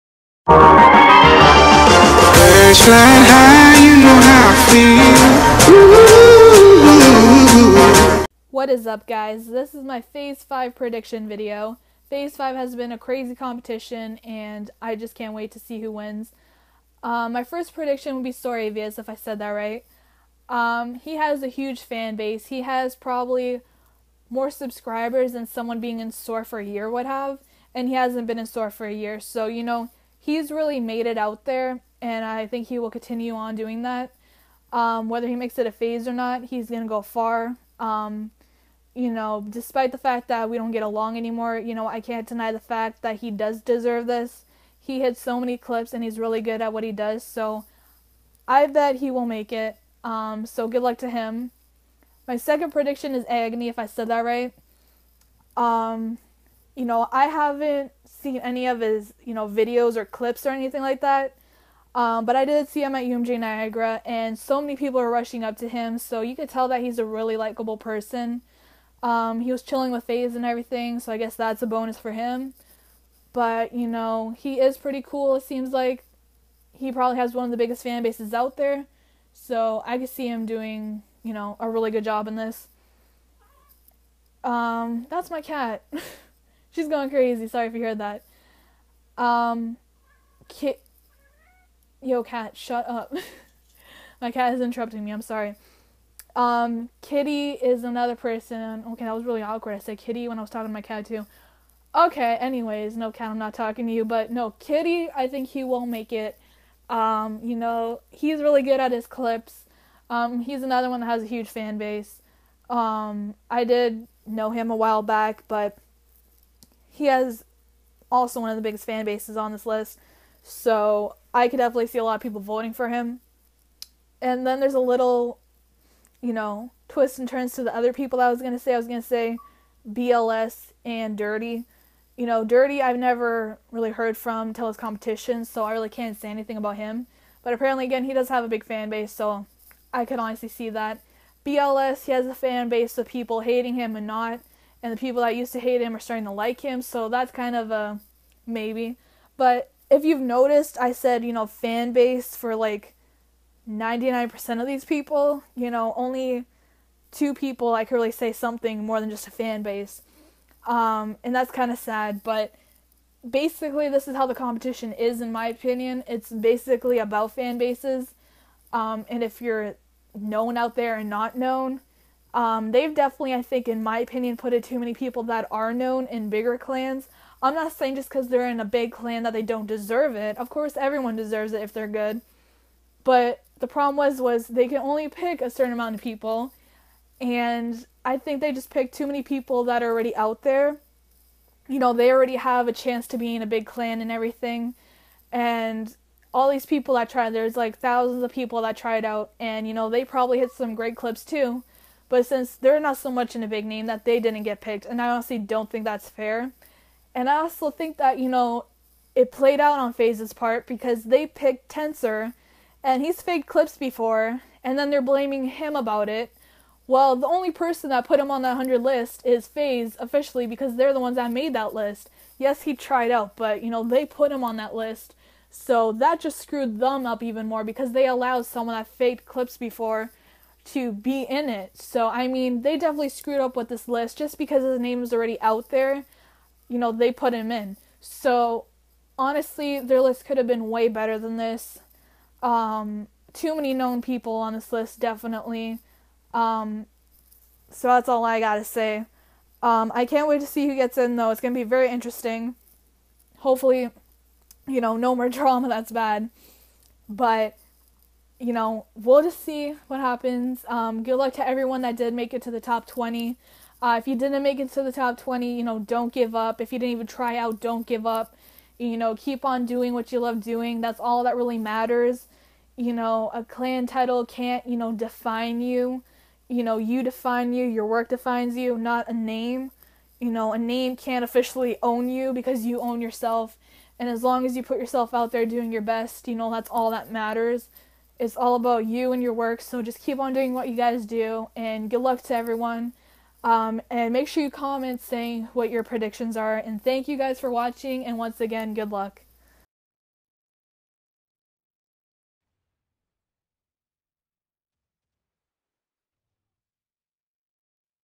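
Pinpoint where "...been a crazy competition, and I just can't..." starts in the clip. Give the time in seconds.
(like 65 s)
12 s.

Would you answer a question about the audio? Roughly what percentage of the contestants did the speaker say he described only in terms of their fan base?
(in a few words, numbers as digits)
99%.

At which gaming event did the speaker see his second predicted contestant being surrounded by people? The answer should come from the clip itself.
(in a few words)
UMG Niagara.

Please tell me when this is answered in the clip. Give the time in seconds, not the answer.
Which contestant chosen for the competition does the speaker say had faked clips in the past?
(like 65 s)
211 s.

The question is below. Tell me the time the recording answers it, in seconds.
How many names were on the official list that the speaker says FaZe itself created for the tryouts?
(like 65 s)
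218 s.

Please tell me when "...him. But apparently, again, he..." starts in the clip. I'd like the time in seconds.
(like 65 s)
136 s.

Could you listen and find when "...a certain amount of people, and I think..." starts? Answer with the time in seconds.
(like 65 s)
185 s.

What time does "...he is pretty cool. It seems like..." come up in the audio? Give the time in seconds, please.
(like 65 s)
74 s.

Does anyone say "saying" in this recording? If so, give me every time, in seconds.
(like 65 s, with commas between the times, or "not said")
177 s, 295 s.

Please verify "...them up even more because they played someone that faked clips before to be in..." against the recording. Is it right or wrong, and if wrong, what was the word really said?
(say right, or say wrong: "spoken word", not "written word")
wrong: "allowed", not "played".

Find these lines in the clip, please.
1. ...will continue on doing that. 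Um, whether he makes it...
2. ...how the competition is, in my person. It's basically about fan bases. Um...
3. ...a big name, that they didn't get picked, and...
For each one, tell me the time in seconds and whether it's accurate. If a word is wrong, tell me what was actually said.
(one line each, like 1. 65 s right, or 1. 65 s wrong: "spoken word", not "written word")
1. 32 s right
2. 164 s wrong: "opinion", not "person"
3. 203 s right.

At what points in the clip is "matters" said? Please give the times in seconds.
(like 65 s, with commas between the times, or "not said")
271 s, 287 s.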